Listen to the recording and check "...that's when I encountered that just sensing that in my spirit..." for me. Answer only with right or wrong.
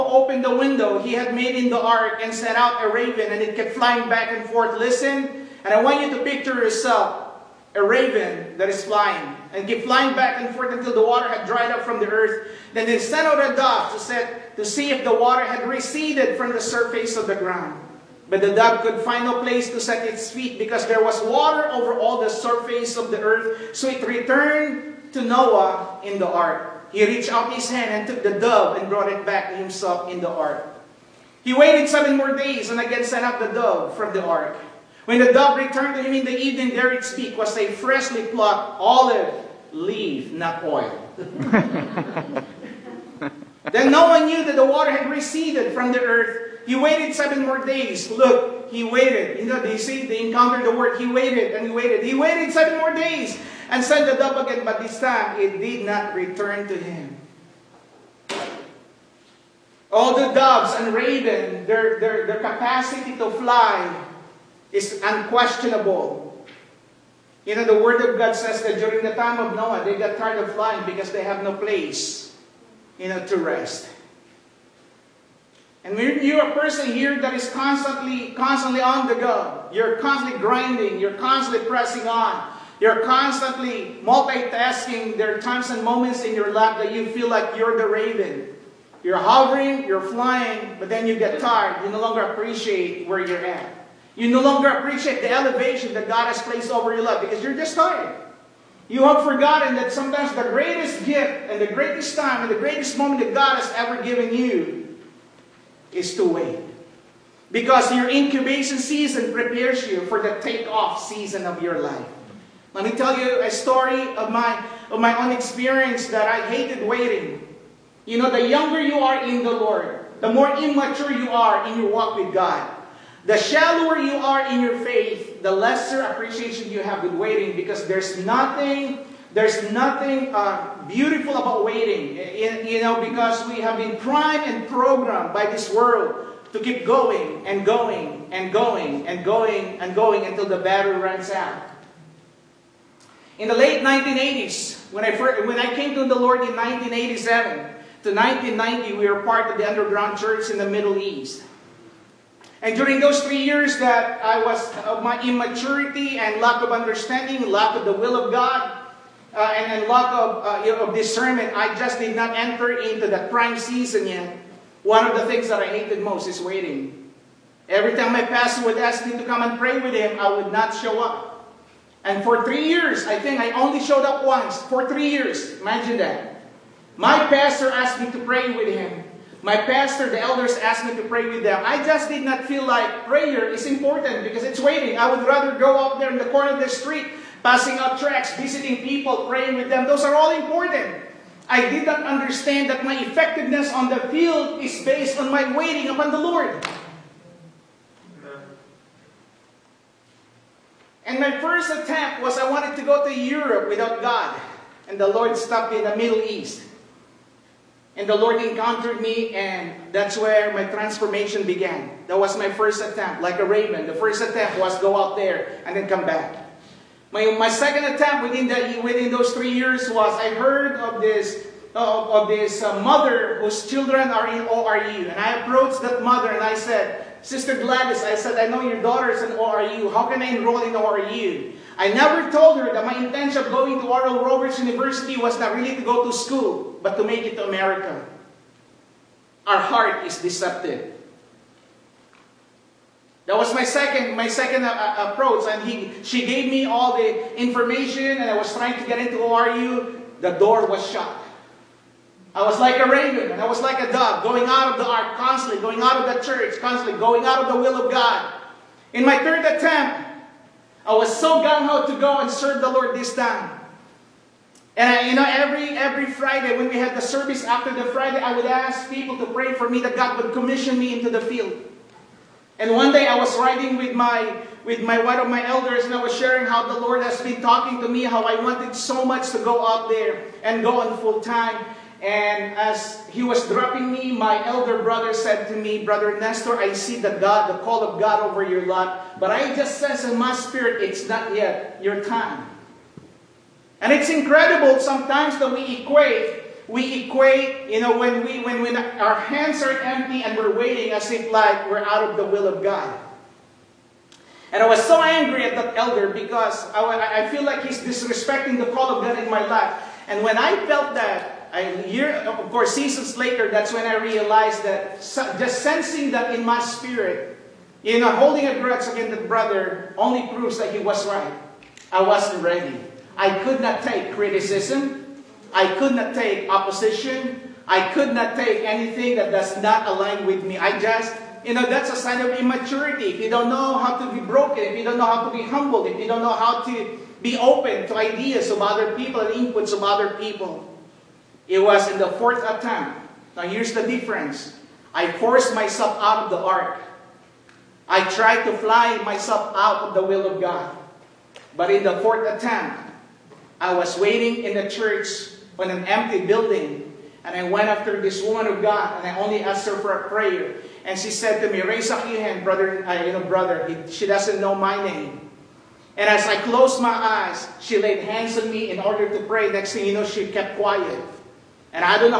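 wrong.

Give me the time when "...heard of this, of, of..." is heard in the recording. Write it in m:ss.
3:40.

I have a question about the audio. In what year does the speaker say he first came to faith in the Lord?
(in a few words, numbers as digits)
1987.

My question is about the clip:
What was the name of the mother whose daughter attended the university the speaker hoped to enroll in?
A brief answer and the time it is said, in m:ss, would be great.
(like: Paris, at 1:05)
Gladys, at 3:47.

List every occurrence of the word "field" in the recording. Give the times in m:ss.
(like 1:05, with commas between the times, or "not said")
3:14, 4:31.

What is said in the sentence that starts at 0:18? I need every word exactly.
But the dove could find no place to set its feet because there was water over all the surface of the earth.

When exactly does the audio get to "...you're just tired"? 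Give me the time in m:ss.
1:37.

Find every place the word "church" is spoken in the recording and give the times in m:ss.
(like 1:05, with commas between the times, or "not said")
2:30, 4:16, 5:54.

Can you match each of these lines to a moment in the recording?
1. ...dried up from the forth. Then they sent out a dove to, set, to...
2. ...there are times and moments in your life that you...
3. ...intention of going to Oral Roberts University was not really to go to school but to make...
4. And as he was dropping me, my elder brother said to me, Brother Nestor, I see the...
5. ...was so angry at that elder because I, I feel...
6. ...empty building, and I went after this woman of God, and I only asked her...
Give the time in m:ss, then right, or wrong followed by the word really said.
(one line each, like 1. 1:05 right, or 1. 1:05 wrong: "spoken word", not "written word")
1. 0:11 wrong: "earth", not "forth"
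2. 1:25 right
3. 3:53 right
4. 4:41 right
5. 5:04 right
6. 5:55 right.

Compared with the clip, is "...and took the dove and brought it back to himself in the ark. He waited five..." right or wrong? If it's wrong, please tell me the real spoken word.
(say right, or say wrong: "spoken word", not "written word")
wrong: "seven", not "five".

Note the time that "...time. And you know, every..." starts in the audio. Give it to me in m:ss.
4:23.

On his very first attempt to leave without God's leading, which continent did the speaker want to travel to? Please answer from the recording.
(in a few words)
Europe.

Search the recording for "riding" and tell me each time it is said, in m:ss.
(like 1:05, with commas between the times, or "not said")
4:33.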